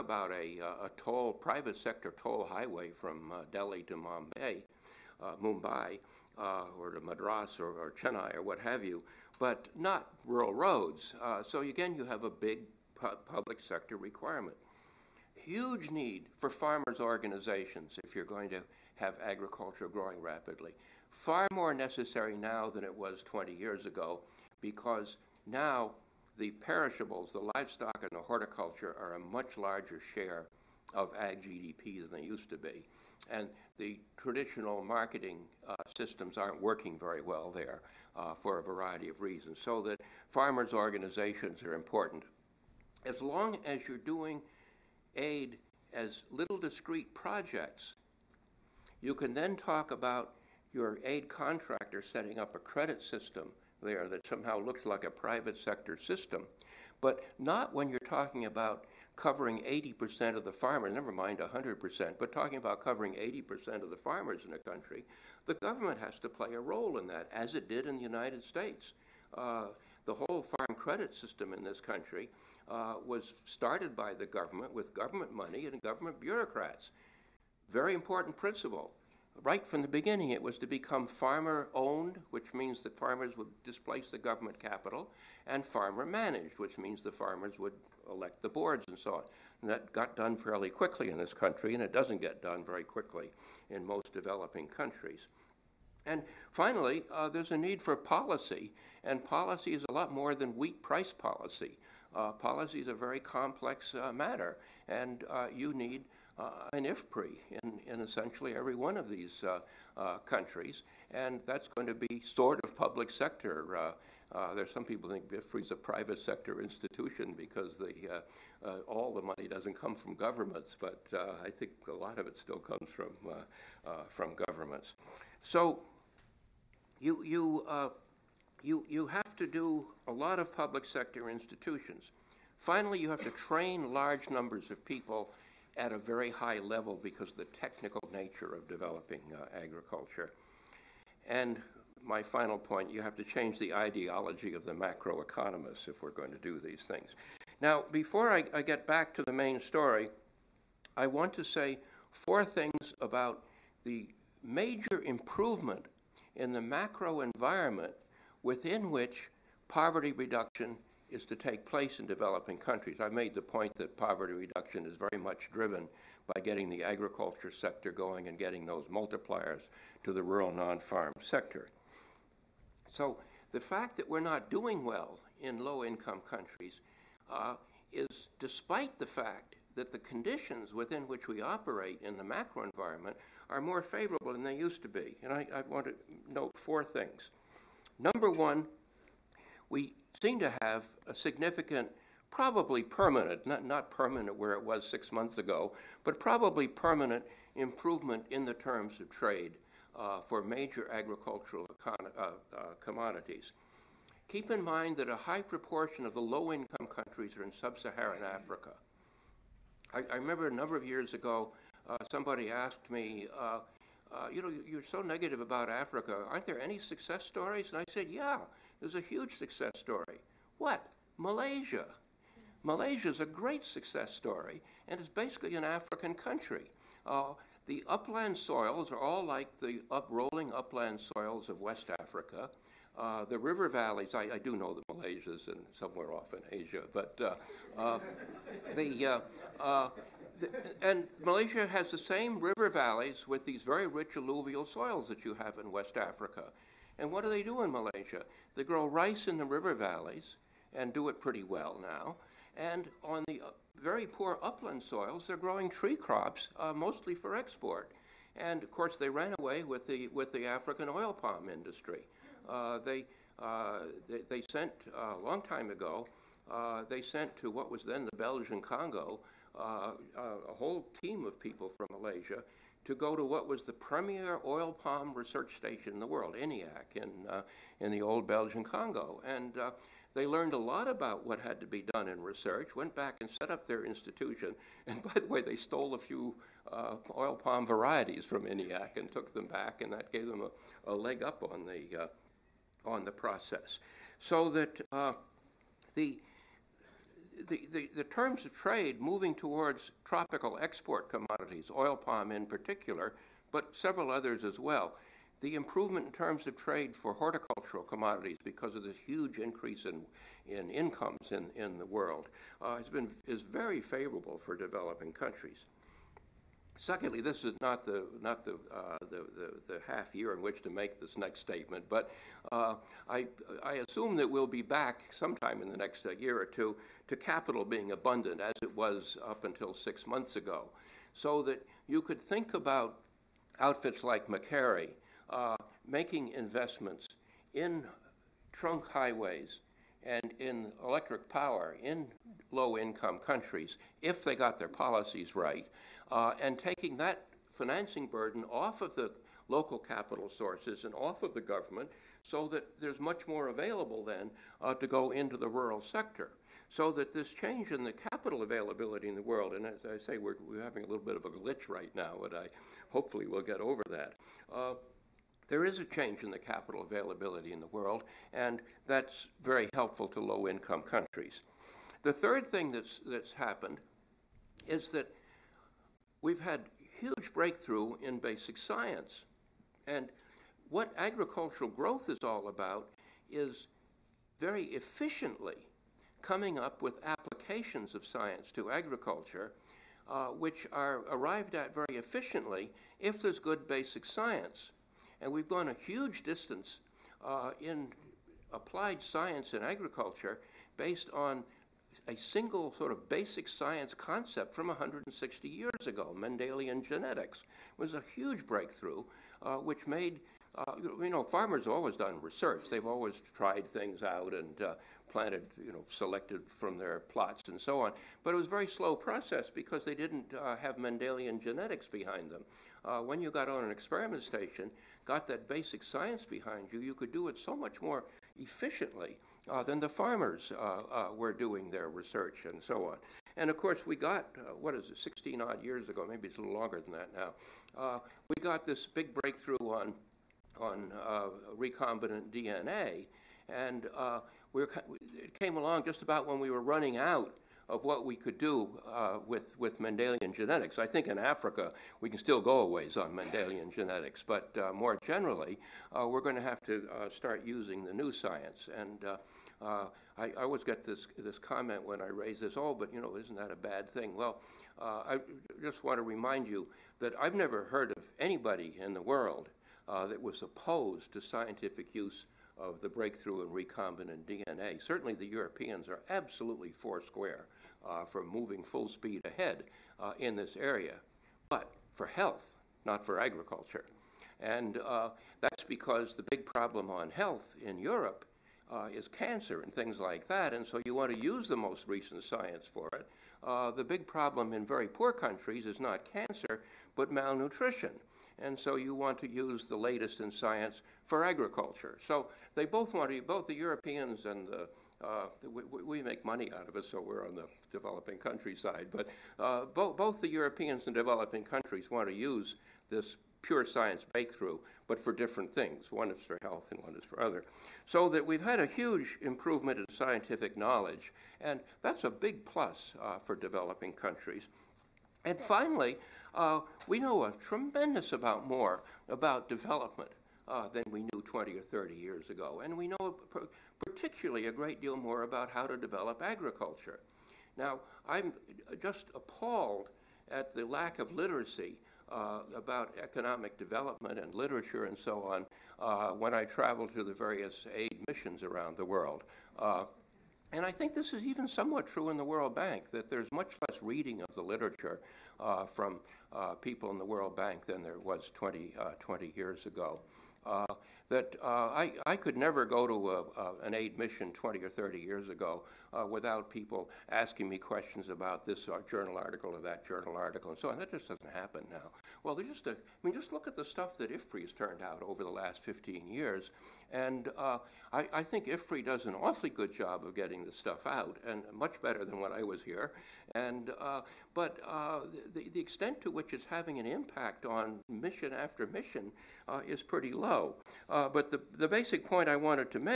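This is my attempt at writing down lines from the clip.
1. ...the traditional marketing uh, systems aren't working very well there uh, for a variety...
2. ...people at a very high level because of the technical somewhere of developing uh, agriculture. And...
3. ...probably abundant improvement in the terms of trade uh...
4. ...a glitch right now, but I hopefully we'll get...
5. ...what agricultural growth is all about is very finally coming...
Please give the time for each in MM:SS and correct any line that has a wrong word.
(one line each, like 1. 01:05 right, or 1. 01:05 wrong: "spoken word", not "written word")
1. 00:33 right
2. 02:14 wrong: "nature", not "somewhere"
3. 03:16 wrong: "permanent", not "abundant"
4. 06:01 right
5. 06:20 wrong: "efficiently", not "finally".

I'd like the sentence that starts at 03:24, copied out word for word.
Keep in mind that a high proportion of the low income countries are in sub Saharan Africa.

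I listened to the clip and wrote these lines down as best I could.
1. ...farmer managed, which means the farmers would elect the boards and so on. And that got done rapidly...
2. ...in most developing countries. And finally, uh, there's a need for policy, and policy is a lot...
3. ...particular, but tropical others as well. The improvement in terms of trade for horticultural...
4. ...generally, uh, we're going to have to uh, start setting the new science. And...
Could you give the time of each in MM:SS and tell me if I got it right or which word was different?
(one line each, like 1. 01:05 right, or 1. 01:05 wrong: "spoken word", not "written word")
1. 01:25 wrong: "fairly", not "rapidly"
2. 01:33 right
3. 05:02 wrong: "several", not "tropical"
4. 07:35 wrong: "using", not "setting".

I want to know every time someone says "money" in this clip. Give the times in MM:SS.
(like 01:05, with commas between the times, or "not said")
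01:15, 01:59, 08:26.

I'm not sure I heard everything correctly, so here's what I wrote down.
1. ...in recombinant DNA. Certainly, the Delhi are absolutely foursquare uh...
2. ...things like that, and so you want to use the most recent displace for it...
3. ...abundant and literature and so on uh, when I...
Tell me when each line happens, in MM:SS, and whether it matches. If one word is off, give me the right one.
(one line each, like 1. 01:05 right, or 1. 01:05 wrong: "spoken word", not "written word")
1. 07:53 wrong: "Europeans", not "Delhi"
2. 08:09 wrong: "science", not "displace"
3. 09:03 wrong: "development", not "abundant".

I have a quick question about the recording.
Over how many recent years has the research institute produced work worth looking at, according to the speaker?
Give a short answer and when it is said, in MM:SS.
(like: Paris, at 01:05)
15, at 09:35.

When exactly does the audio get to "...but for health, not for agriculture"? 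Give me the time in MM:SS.
08:01.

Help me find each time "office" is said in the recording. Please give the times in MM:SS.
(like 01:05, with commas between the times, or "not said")
not said.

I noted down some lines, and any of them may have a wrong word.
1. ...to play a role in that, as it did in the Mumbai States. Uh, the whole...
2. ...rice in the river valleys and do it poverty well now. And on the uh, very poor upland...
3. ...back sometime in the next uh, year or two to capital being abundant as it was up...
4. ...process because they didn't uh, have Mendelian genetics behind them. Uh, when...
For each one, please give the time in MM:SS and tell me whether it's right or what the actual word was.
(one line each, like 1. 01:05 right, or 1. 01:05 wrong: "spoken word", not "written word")
1. 01:06 wrong: "United", not "Mumbai"
2. 04:08 wrong: "pretty", not "poverty"
3. 05:24 right
4. 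06:58 right.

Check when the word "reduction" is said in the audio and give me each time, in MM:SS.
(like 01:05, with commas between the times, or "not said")
02:40, 02:44.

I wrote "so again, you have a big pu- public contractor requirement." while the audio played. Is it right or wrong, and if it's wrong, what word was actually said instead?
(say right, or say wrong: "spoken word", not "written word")
wrong: "sector", not "contractor".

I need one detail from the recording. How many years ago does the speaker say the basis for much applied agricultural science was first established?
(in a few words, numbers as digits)
160.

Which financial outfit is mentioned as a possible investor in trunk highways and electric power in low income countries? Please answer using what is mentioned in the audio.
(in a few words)
Macquarie.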